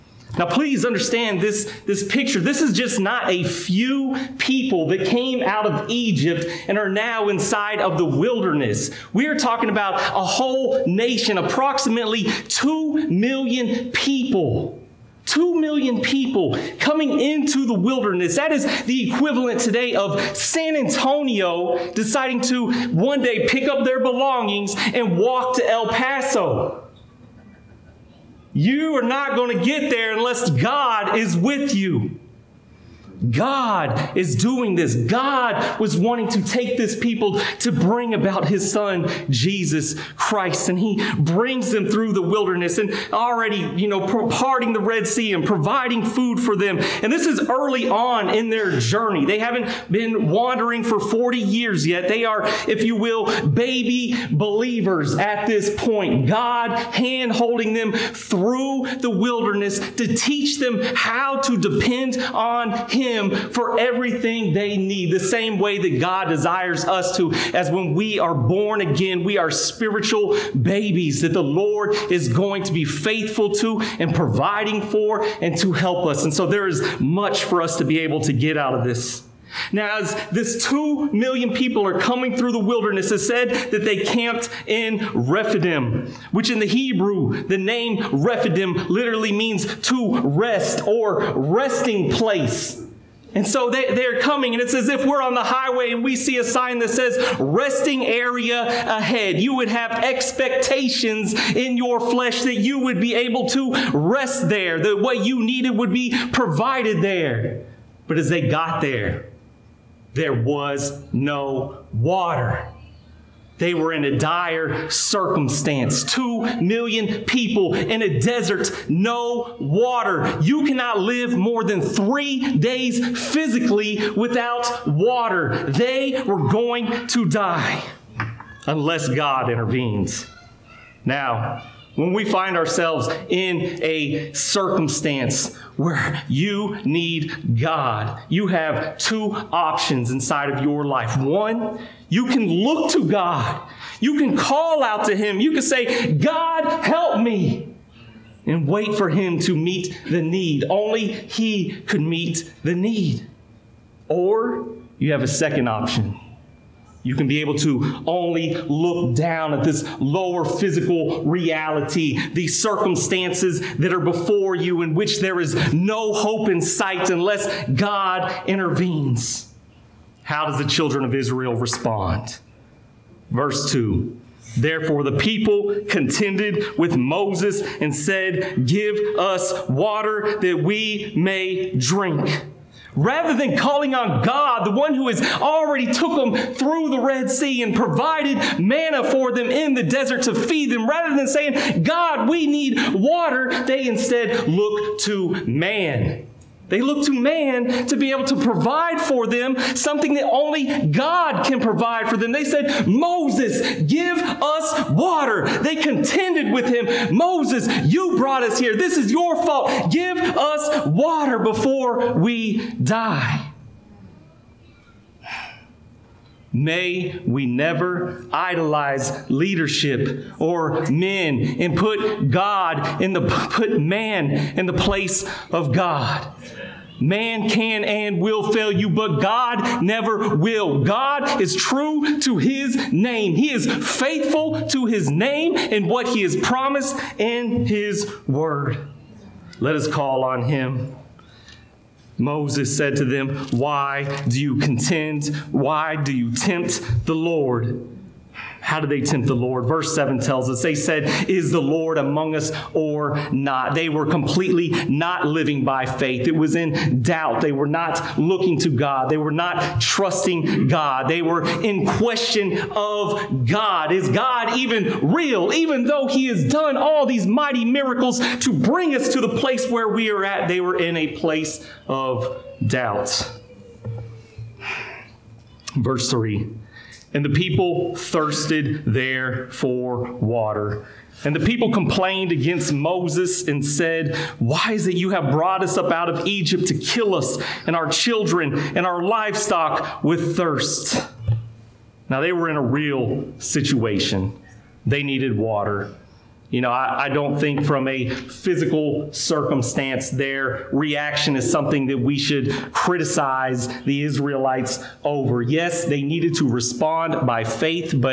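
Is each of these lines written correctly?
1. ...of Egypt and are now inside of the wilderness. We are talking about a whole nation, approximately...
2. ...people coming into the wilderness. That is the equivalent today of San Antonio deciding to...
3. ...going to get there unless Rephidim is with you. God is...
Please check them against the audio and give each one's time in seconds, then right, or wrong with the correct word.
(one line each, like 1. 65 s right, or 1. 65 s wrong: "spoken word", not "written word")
1. 5 s right
2. 16 s right
3. 29 s wrong: "God", not "Rephidim".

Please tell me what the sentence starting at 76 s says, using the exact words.
And so there is much for us to be able to get out of this.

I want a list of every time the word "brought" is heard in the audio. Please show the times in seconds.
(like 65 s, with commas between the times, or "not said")
208 s, 285 s.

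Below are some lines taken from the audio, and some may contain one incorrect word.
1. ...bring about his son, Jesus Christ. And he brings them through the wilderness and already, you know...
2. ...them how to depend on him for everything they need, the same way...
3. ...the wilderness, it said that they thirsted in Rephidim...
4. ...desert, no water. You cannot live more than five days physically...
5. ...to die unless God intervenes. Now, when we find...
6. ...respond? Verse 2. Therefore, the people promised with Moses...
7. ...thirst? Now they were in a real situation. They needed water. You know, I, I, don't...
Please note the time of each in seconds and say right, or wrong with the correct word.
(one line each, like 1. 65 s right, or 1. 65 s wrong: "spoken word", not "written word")
1. 37 s right
2. 60 s right
3. 82 s wrong: "camped", not "thirsted"
4. 118 s wrong: "three", not "five"
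5. 127 s right
6. 171 s wrong: "contended", not "promised"
7. 290 s right.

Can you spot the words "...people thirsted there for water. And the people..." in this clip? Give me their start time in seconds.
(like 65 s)
277 s.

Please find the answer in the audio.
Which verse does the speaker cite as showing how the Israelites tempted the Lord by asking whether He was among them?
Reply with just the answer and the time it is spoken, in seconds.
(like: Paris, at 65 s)
Verse 7, at 249 s.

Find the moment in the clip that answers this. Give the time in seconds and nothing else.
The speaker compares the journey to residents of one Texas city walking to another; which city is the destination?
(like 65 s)
25 s.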